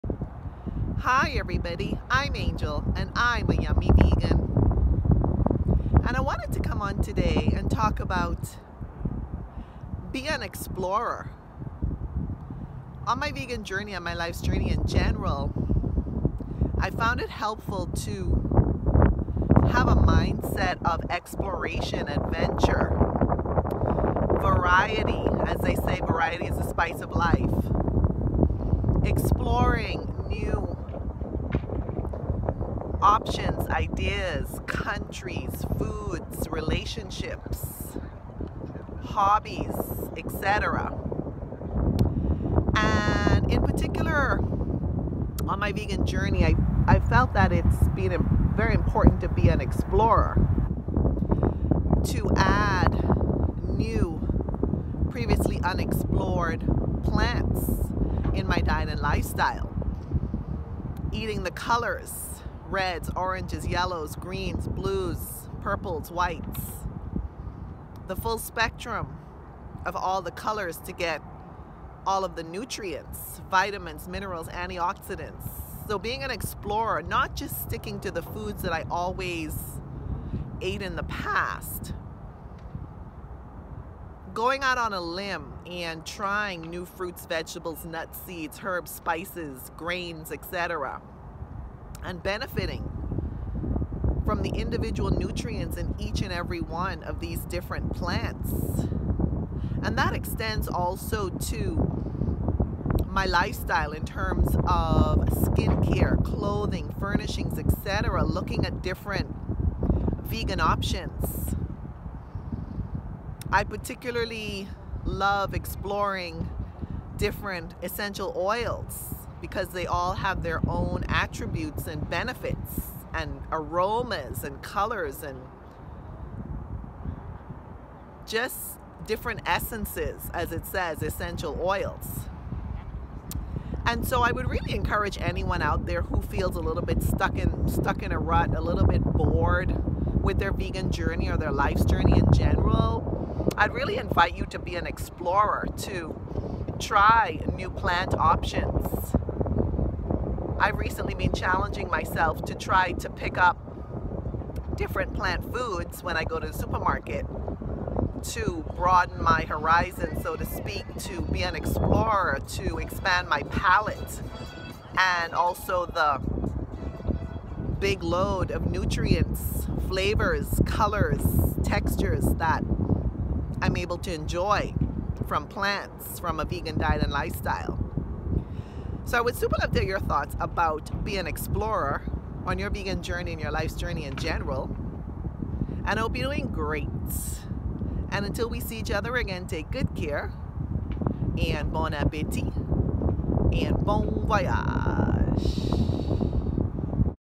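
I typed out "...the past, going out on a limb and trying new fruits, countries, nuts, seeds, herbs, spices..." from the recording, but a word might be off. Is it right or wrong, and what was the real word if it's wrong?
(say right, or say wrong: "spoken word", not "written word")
wrong: "vegetables", not "countries".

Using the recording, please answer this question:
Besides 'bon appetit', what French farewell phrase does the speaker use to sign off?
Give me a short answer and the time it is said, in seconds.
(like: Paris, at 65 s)
Bon voyage, at 193 s.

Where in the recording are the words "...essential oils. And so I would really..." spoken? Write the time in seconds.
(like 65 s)
131 s.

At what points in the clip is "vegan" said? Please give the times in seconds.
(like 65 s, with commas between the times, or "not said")
3 s, 13 s, 45 s, 110 s, 140 s, 176 s, 182 s.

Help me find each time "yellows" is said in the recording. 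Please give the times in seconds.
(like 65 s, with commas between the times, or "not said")
63 s.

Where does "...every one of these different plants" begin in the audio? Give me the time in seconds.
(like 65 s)
96 s.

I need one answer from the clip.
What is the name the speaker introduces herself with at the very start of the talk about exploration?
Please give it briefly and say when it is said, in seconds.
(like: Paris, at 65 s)
Angel, at 2 s.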